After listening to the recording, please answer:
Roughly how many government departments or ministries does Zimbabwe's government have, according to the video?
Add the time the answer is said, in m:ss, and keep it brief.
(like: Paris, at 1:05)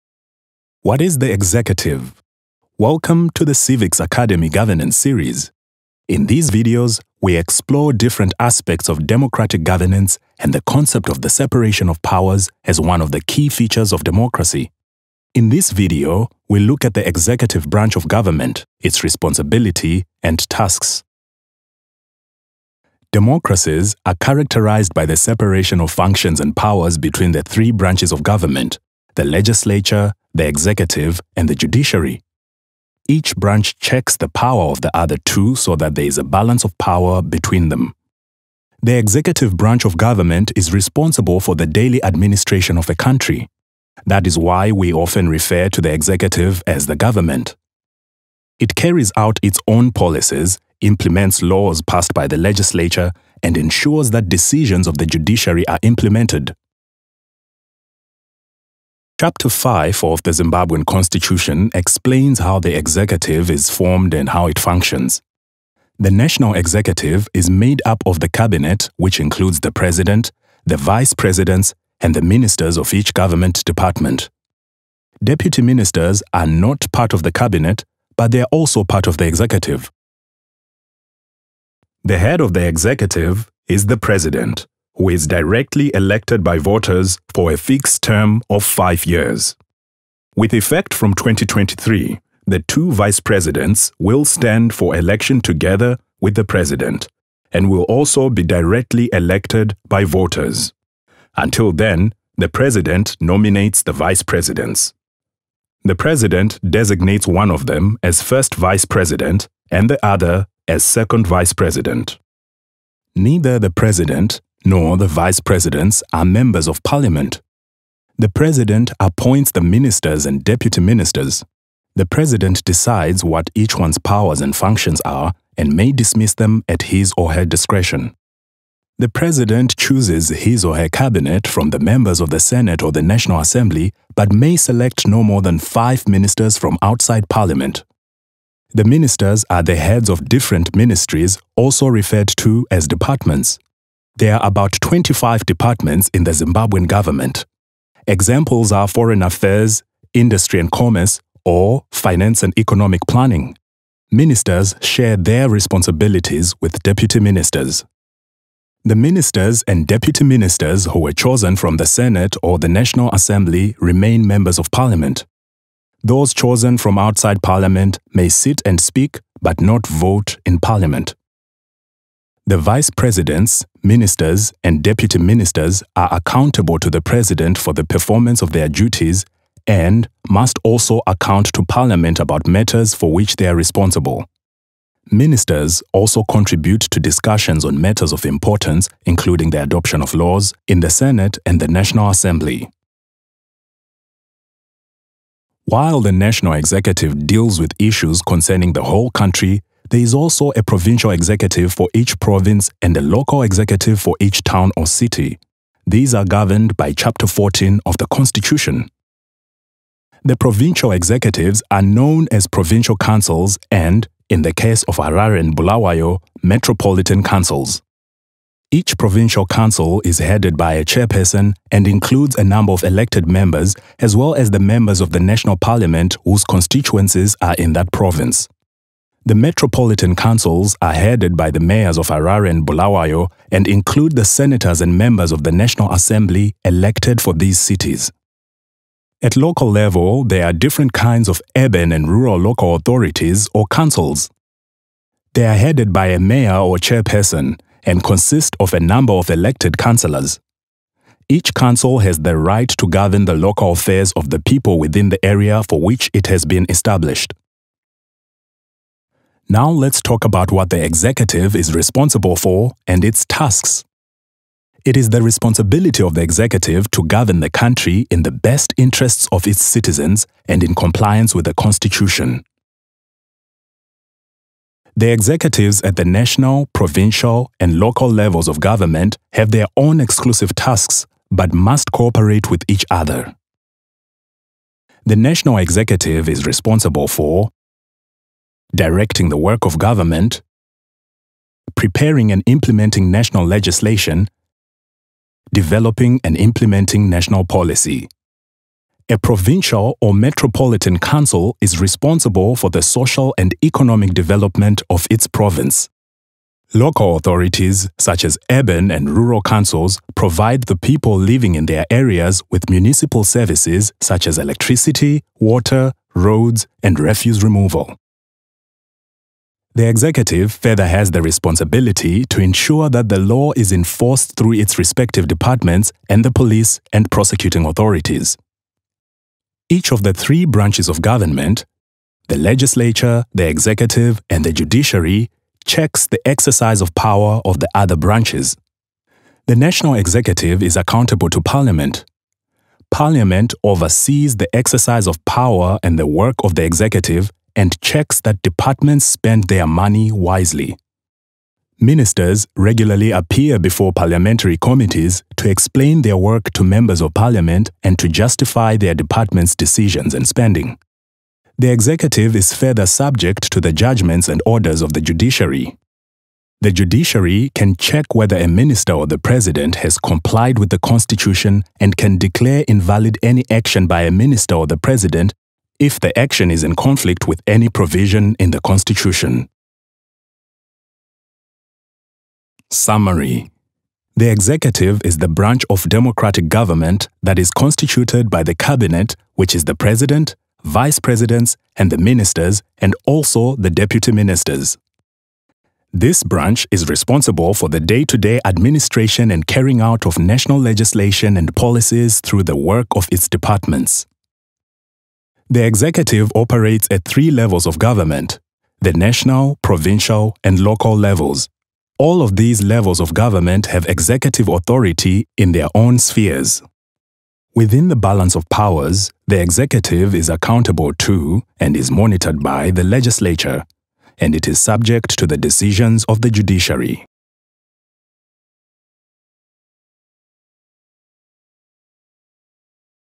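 About 25, at 2:24.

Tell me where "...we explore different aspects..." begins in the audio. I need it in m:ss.
0:07.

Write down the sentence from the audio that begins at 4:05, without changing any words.
They are headed by a mayor or chairperson and consist of a number of elected councillors.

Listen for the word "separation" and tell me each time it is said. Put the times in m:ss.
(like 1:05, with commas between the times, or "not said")
0:11, 0:25.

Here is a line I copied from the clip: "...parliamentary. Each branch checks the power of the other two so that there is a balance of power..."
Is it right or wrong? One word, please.
wrong.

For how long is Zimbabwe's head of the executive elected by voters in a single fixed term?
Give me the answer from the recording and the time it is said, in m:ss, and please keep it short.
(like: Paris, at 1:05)
5 years, at 1:28.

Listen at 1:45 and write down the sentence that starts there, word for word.
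The president designates one of them as first vice president and the other as second vice president.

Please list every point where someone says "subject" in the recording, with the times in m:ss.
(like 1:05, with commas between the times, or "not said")
6:02, 7:04.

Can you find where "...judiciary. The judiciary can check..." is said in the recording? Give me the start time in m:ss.
6:05.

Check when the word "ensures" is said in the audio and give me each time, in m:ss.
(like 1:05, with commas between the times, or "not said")
0:53, 5:22.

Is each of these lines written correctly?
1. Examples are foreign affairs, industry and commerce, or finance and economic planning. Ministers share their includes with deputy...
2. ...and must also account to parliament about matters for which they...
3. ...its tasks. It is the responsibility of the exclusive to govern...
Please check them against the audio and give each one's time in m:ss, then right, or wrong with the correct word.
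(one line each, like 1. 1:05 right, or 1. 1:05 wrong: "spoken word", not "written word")
1. 2:28 wrong: "responsibilities", not "includes"
2. 2:59 right
3. 4:23 wrong: "executive", not "exclusive".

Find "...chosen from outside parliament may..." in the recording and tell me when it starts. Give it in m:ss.
2:46.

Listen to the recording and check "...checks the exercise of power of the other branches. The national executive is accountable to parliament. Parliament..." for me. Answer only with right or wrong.
right.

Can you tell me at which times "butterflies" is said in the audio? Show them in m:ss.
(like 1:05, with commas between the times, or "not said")
not said.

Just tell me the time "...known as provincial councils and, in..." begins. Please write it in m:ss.
3:31.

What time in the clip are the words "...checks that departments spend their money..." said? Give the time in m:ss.
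5:47.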